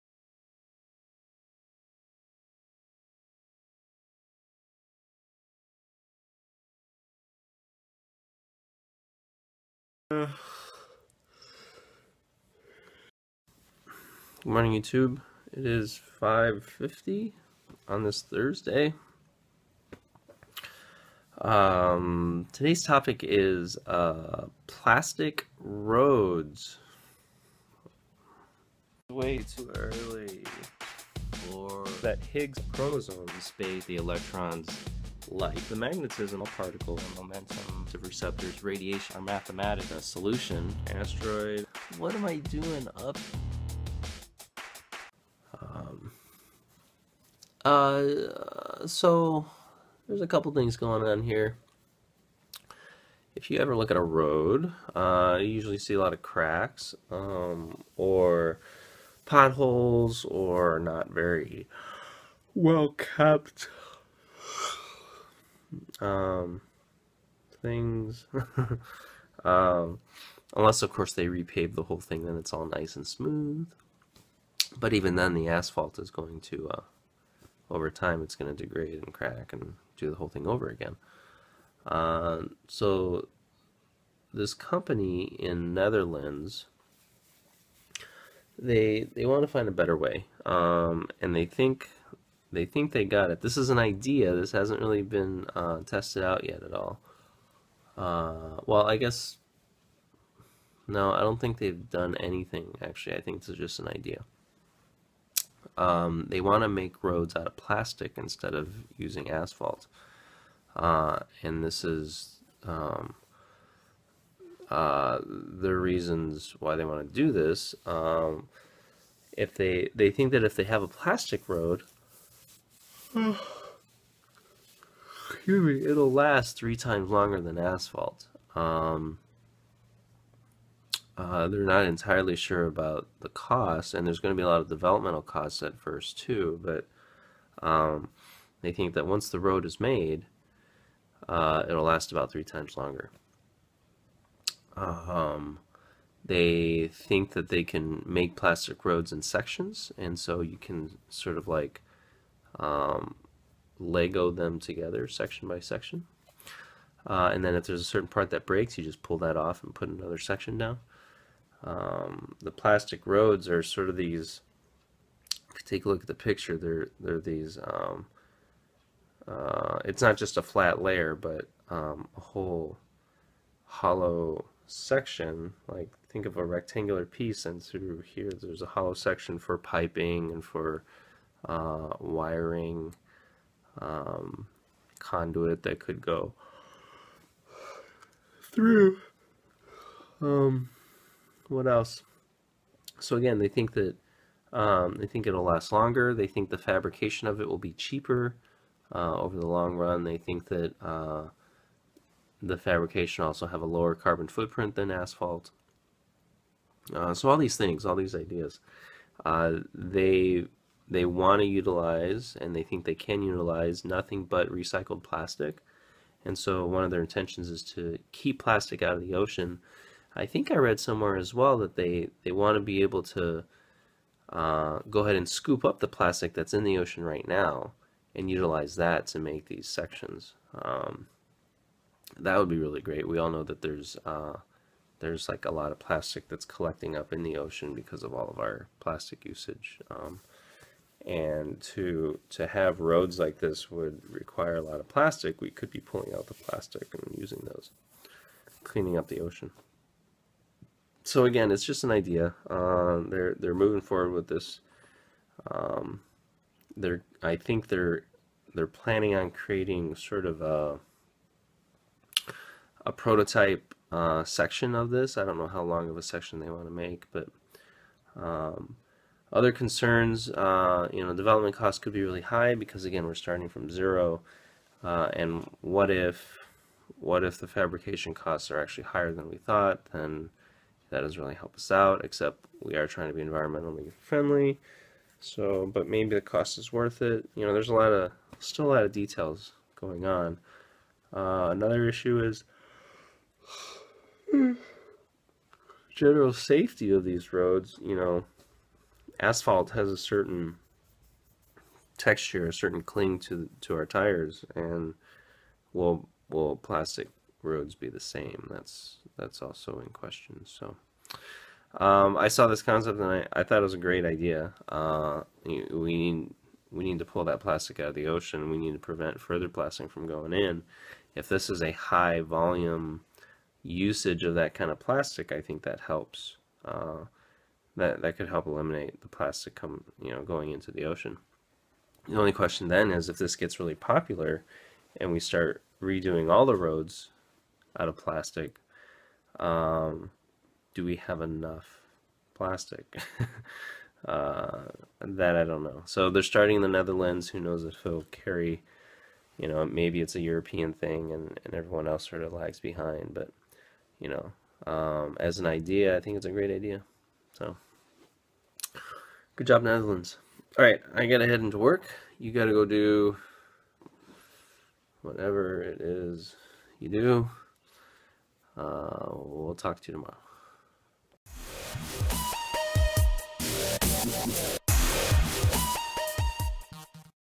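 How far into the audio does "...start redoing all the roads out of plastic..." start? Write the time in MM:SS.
05:35.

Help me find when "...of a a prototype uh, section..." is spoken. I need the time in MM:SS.
04:20.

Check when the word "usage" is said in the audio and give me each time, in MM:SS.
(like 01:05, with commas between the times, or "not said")
03:59, 05:23.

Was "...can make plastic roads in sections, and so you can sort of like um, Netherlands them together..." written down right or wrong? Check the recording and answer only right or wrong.
wrong.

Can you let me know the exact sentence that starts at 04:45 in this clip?
So, but maybe the cost is worth it.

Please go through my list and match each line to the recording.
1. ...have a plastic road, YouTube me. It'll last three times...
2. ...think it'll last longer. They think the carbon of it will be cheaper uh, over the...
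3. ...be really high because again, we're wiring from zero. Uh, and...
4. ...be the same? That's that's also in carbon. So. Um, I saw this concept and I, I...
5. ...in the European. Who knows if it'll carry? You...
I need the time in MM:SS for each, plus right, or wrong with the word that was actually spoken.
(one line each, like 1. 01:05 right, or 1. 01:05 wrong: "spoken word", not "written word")
1. 02:00 wrong: "Excuse", not "YouTube"
2. 03:15 wrong: "fabrication", not "carbon"
3. 04:31 wrong: "starting", not "wiring"
4. 05:07 wrong: "question", not "carbon"
5. 05:46 wrong: "Netherlands", not "European".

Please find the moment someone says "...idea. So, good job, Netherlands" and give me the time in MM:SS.
05:56.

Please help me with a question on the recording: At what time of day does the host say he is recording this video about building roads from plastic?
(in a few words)
5:50.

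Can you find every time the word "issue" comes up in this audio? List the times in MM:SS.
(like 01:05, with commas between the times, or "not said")
04:51.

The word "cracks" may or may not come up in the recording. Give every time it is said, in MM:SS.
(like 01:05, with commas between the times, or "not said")
00:56, 01:19.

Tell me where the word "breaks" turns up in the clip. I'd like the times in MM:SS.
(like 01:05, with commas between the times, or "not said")
02:38.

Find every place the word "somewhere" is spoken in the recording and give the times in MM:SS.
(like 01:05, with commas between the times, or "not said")
03:40.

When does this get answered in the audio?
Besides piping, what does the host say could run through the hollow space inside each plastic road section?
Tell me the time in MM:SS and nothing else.
03:01.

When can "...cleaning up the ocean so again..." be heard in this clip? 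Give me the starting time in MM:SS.
04:08.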